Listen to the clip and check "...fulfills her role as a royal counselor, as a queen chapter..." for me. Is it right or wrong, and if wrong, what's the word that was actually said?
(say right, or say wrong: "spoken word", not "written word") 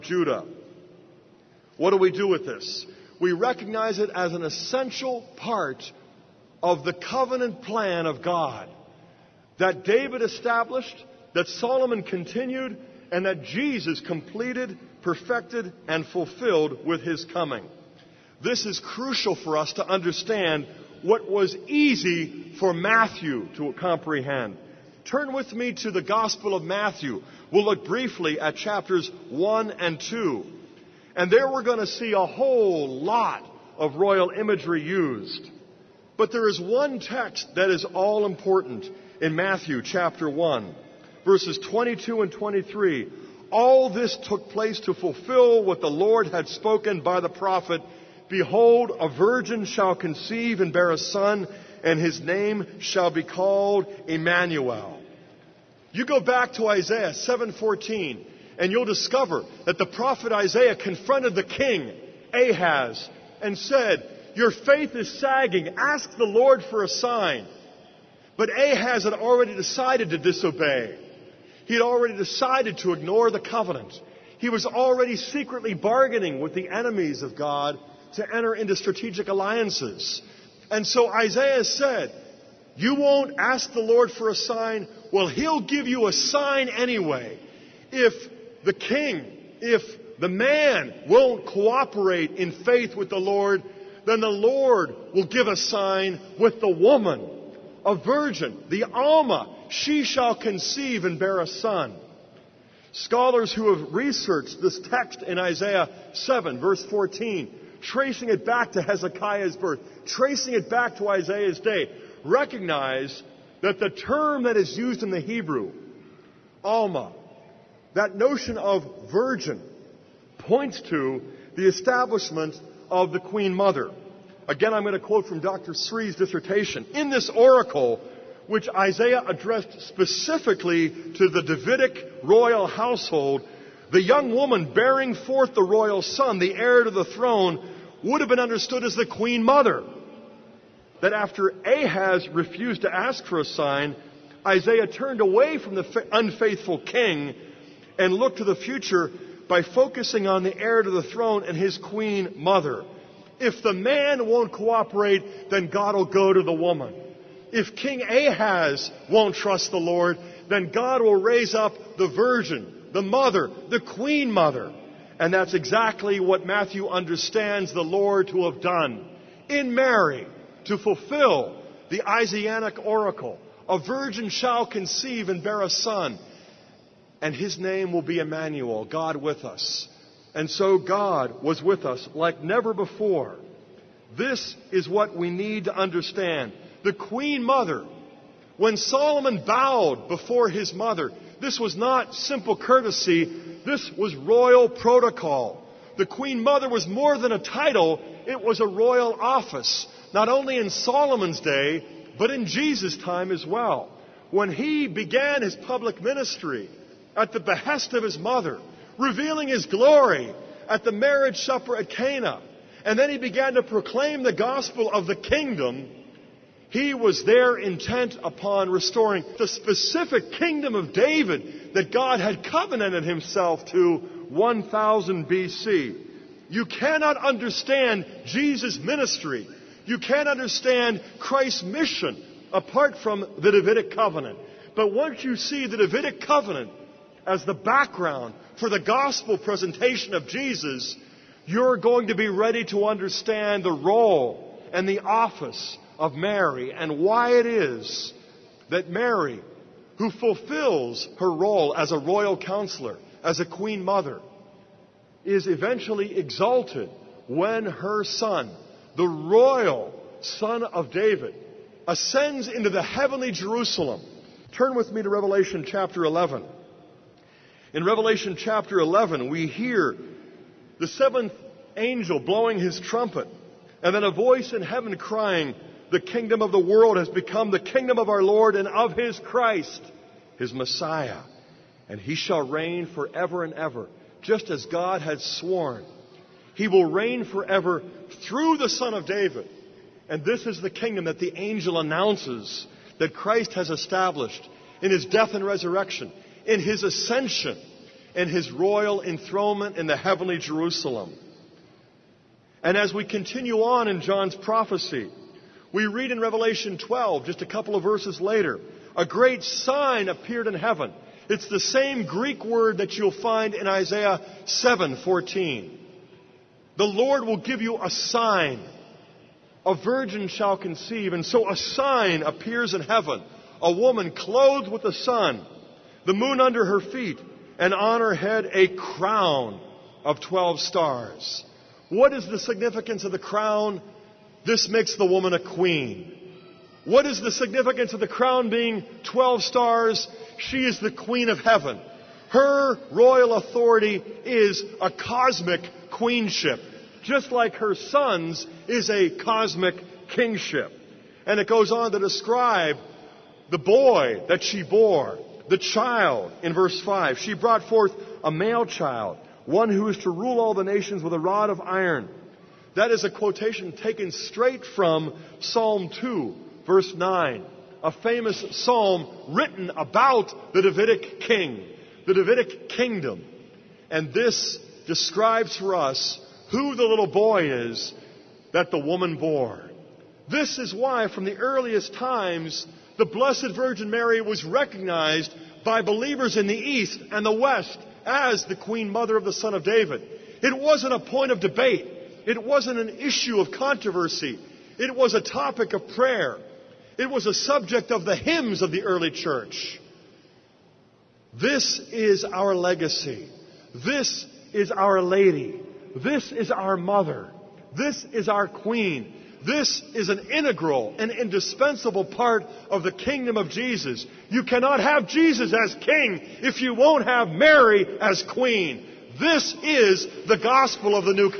wrong: "mother", not "chapter".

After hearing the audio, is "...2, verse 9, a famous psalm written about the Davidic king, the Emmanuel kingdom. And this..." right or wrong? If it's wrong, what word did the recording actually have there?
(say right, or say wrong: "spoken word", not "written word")
wrong: "Davidic", not "Emmanuel".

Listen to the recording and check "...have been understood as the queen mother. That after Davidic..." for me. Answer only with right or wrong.
wrong.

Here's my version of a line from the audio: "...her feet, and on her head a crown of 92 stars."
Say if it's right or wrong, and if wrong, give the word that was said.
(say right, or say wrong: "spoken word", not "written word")
wrong: "12", not "92".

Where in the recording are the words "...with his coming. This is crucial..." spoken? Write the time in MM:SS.
00:16.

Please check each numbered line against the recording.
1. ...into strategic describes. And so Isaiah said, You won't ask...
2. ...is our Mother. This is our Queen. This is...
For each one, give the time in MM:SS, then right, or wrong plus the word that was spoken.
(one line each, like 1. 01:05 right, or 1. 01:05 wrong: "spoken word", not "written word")
1. 01:18 wrong: "alliances", not "describes"
2. 06:46 right.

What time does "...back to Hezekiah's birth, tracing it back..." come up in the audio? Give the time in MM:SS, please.
01:48.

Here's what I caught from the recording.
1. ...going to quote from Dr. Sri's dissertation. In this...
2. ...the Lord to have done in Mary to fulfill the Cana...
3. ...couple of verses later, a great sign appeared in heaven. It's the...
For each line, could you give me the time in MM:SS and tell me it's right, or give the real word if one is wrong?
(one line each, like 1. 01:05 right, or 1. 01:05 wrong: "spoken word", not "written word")
1. 02:04 right
2. 02:47 wrong: "Isaianic", not "Cana"
3. 05:07 right.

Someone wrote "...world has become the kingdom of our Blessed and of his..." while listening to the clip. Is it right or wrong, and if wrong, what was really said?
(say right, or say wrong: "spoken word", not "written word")
wrong: "Lord", not "Blessed".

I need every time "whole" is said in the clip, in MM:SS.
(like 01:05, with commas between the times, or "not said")
00:32.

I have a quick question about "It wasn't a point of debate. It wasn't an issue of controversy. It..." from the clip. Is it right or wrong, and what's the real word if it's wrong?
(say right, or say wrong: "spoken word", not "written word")
right.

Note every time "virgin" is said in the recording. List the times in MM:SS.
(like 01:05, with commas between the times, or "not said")
00:49, 01:37, 01:59, 02:42, 02:53, 05:19, 06:23.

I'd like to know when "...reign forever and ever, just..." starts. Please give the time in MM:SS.
04:42.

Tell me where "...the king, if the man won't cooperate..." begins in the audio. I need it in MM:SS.
01:28.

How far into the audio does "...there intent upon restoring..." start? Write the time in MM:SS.
03:37.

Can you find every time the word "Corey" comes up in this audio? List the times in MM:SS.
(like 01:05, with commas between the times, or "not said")
not said.